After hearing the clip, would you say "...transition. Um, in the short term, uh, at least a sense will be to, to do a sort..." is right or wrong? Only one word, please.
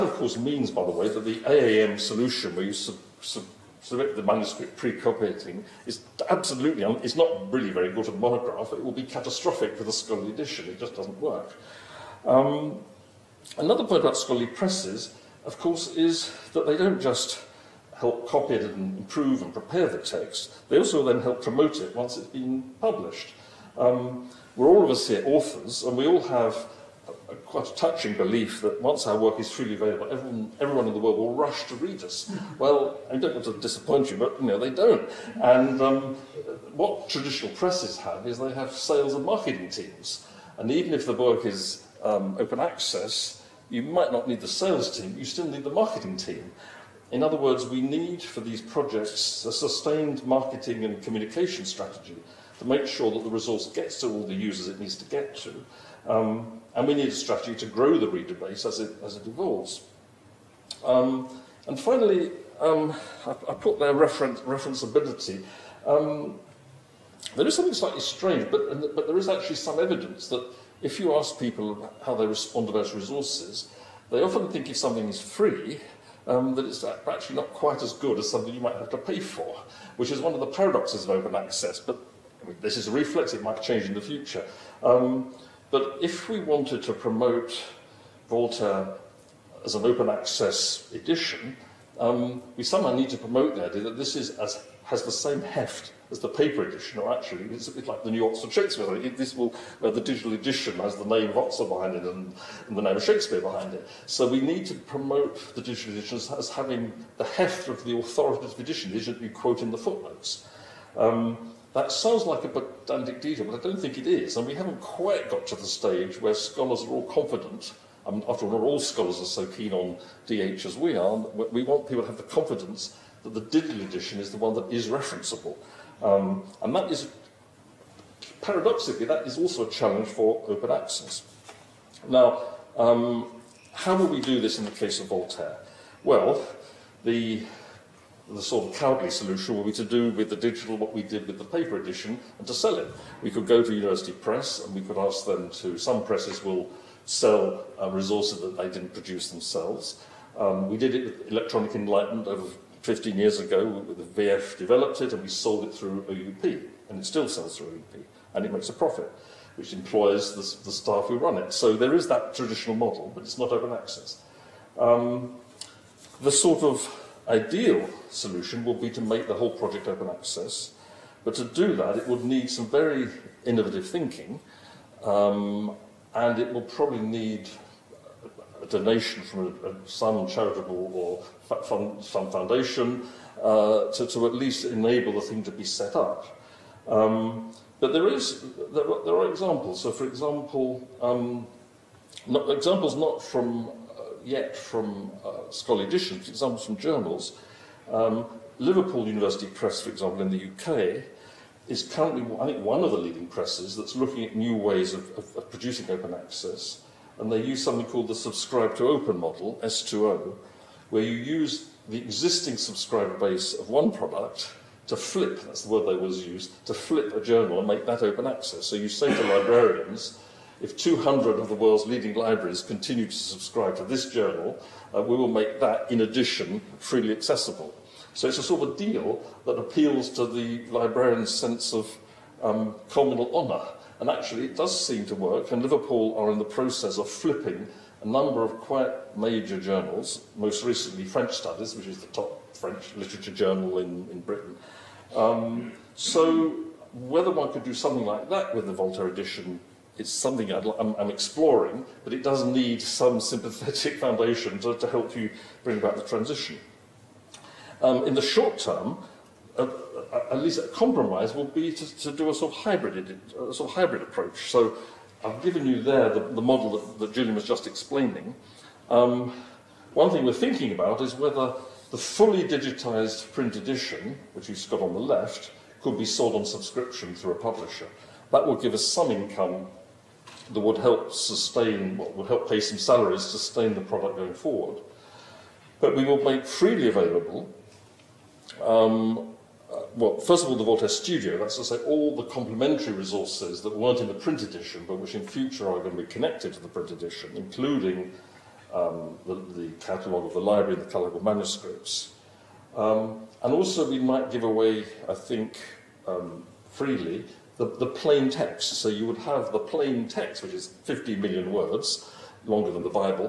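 wrong.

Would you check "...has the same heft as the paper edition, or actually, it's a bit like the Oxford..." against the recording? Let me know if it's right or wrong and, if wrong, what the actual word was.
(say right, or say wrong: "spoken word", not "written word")
wrong: "New", not "Oxford".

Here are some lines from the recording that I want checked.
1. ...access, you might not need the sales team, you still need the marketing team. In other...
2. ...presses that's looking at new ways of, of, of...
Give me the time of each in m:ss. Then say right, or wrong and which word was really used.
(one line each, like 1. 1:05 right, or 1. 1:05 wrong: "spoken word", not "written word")
1. 0:42 right
2. 3:23 right.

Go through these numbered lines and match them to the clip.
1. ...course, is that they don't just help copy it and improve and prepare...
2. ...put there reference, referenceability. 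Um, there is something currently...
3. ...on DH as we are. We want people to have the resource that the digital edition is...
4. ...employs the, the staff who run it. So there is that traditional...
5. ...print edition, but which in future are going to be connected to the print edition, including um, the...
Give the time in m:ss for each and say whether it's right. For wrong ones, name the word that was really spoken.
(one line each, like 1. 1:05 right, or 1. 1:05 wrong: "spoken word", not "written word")
1. 0:15 right
2. 1:03 wrong: "slightly", not "currently"
3. 1:59 wrong: "confidence", not "resource"
4. 2:39 right
5. 4:54 right.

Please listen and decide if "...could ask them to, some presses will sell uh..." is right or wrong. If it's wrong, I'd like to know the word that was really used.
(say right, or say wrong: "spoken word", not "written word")
right.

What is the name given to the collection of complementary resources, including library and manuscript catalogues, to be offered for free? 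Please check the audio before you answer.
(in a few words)
Voltaire Studio.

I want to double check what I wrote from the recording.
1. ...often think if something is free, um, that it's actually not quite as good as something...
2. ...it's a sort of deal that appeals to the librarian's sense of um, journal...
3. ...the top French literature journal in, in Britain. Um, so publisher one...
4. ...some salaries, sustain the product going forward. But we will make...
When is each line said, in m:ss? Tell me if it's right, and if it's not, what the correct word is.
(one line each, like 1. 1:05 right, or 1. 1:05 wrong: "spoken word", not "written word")
1. 1:14 right
2. 3:48 wrong: "communal", not "journal"
3. 4:01 wrong: "whether", not "publisher"
4. 4:42 right.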